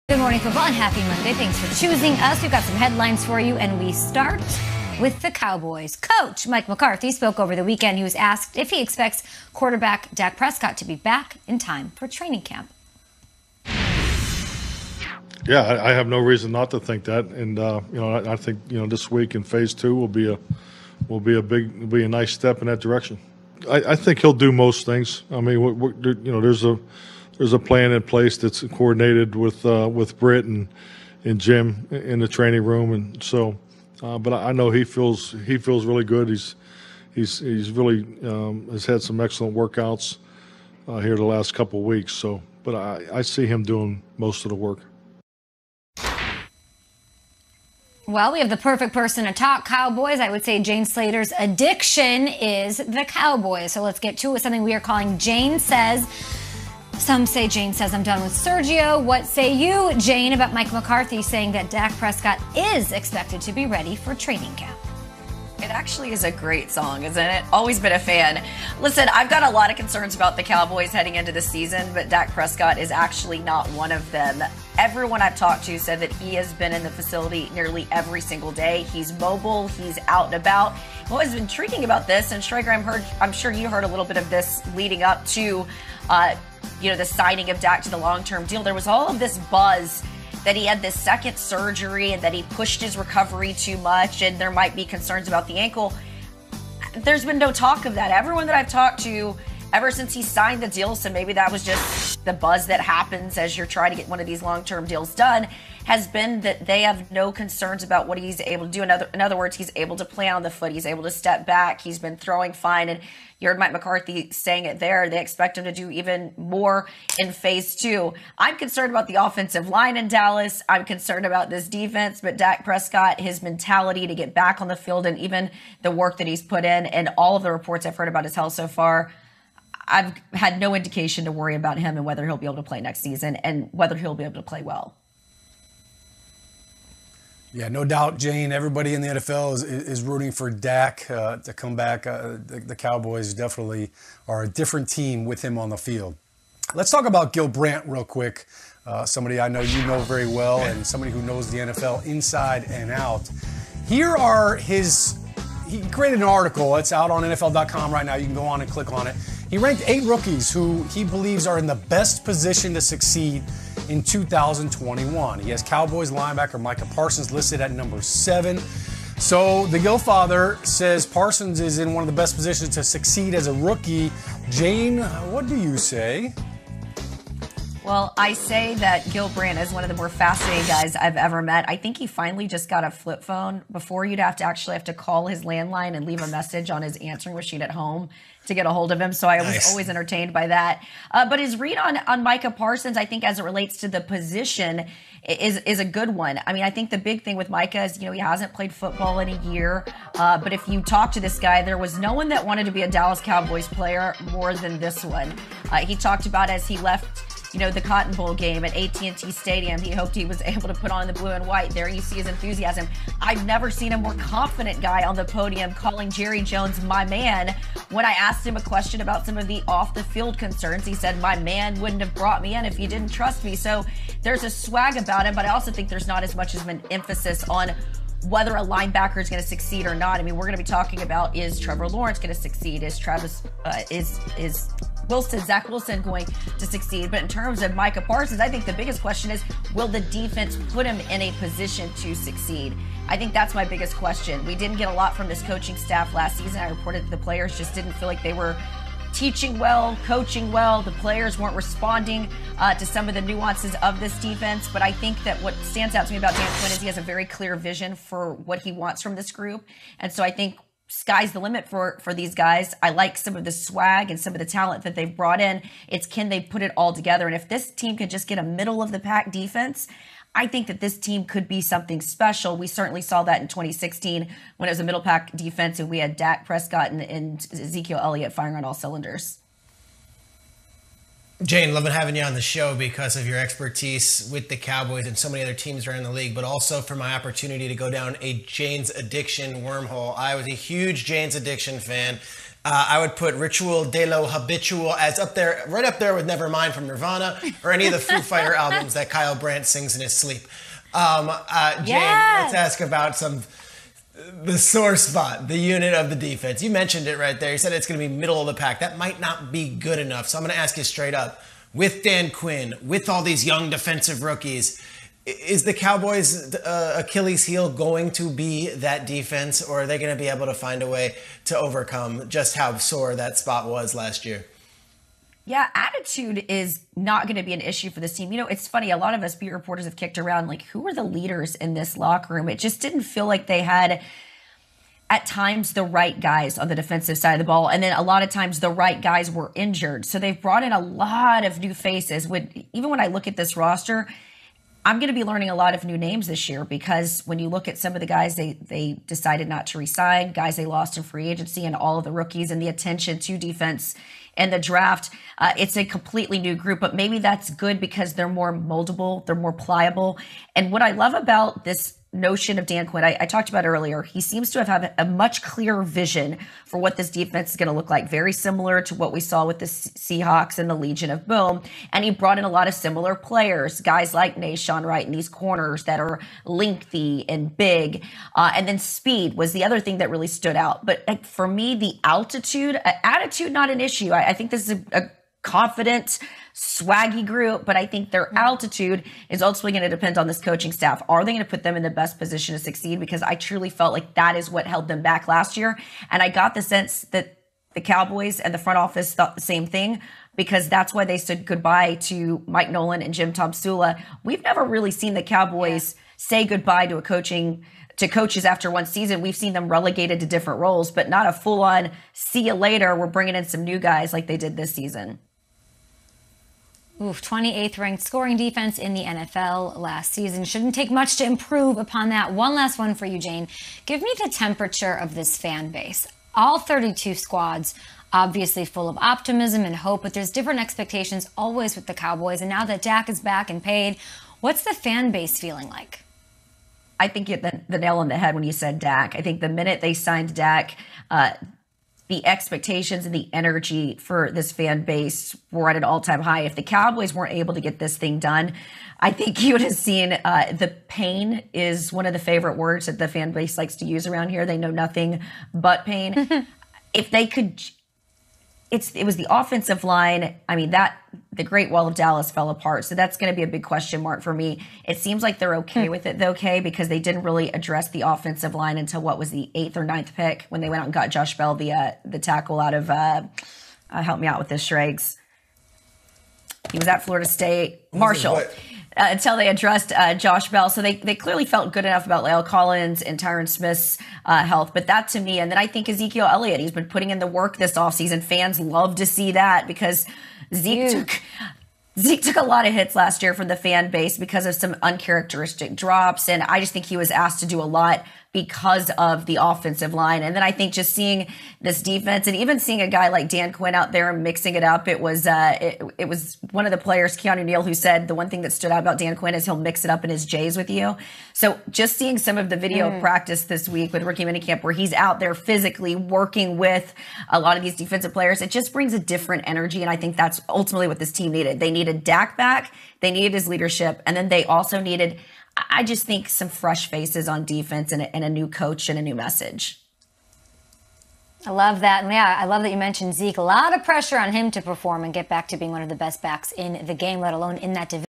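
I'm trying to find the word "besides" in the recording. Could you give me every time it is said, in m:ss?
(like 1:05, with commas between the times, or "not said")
not said.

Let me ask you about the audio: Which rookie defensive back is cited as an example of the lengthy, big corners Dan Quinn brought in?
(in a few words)
Nahshon Wright.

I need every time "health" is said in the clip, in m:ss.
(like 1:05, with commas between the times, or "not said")
2:08, 8:04.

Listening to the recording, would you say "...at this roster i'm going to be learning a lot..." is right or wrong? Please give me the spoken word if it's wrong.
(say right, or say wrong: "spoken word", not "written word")
right.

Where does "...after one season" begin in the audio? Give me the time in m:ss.
6:48.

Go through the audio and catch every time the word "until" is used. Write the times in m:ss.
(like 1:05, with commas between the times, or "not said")
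7:48, 7:59.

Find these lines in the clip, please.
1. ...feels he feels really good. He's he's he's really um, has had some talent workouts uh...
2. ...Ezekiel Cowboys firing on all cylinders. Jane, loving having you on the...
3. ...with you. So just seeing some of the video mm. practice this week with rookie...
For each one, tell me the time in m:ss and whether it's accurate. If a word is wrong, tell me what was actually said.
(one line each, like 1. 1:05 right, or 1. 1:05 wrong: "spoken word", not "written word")
1. 0:34 wrong: "excellent", not "talent"
2. 4:37 wrong: "Elliott", not "Cowboys"
3. 8:30 right.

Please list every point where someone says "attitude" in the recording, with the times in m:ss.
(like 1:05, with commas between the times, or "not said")
5:25, 6:23.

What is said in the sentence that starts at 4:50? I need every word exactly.
I was a huge Jane's addiction fan.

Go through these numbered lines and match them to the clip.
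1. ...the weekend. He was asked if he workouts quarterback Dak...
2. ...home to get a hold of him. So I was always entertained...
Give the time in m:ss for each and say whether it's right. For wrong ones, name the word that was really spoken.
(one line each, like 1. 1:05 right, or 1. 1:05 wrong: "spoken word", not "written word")
1. 0:07 wrong: "expects", not "workouts"
2. 3:07 right.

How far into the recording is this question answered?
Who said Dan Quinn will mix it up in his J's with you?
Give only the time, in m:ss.
8:27.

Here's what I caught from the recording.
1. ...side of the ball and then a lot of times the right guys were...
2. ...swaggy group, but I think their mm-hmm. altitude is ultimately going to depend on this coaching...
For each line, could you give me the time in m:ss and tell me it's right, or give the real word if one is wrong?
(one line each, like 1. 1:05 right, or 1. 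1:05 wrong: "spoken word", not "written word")
1. 5:37 right
2. 6:26 right.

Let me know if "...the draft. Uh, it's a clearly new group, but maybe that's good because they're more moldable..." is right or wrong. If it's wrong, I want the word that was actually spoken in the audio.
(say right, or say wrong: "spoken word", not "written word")
wrong: "completely", not "clearly".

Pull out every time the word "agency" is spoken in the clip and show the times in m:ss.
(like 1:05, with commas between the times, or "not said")
5:51.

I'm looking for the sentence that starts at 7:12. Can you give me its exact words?
And now that Dak is back and paid, what's the fan base feeling like?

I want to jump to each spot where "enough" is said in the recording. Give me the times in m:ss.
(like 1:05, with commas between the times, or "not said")
5:09, 8:01.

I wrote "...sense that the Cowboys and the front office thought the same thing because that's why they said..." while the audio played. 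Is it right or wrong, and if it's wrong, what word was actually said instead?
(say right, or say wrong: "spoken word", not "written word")
right.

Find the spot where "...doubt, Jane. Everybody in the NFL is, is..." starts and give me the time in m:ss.
2:17.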